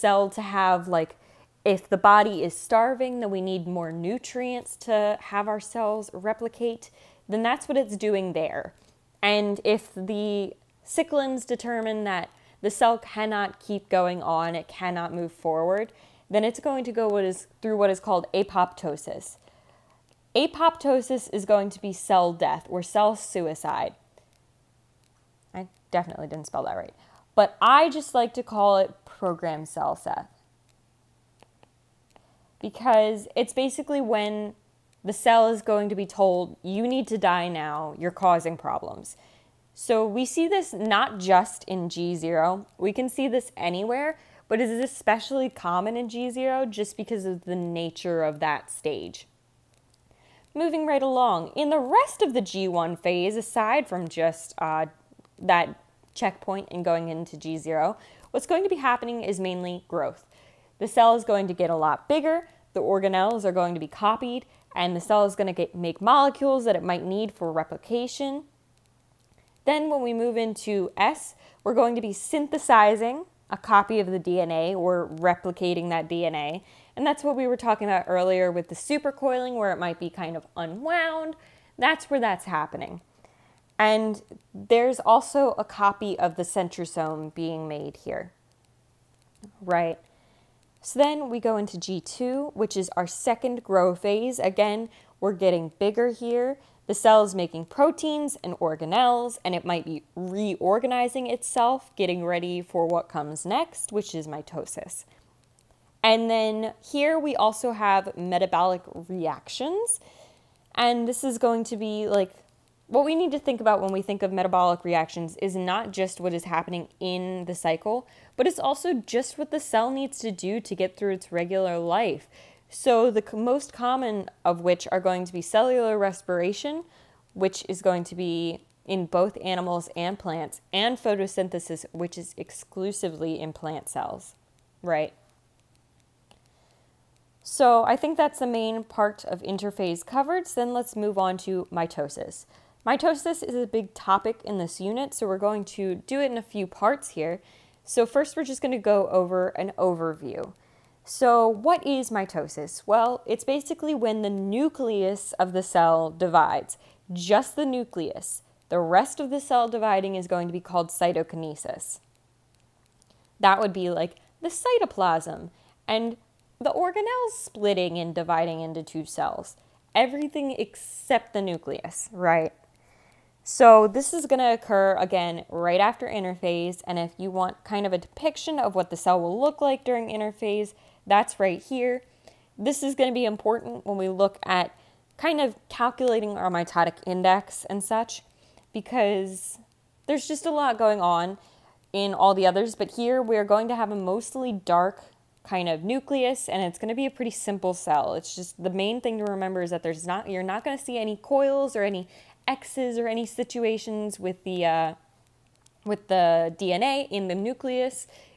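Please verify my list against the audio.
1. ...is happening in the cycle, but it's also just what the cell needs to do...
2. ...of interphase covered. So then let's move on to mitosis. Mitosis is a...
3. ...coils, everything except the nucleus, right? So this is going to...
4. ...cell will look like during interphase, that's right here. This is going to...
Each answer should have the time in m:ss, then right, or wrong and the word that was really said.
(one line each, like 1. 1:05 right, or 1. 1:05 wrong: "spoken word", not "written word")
1. 1:56 right
2. 2:19 right
3. 2:49 wrong: "cells", not "coils"
4. 2:58 right.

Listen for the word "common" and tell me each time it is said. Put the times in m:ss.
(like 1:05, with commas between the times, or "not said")
0:45, 2:03.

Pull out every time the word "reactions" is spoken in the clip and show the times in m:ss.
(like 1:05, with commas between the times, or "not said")
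1:49, 1:54.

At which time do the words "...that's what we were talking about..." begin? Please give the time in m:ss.
1:17.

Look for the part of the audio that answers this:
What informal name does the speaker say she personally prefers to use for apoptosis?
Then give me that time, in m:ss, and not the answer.
0:29.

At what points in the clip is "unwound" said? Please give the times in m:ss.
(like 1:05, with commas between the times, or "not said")
1:20.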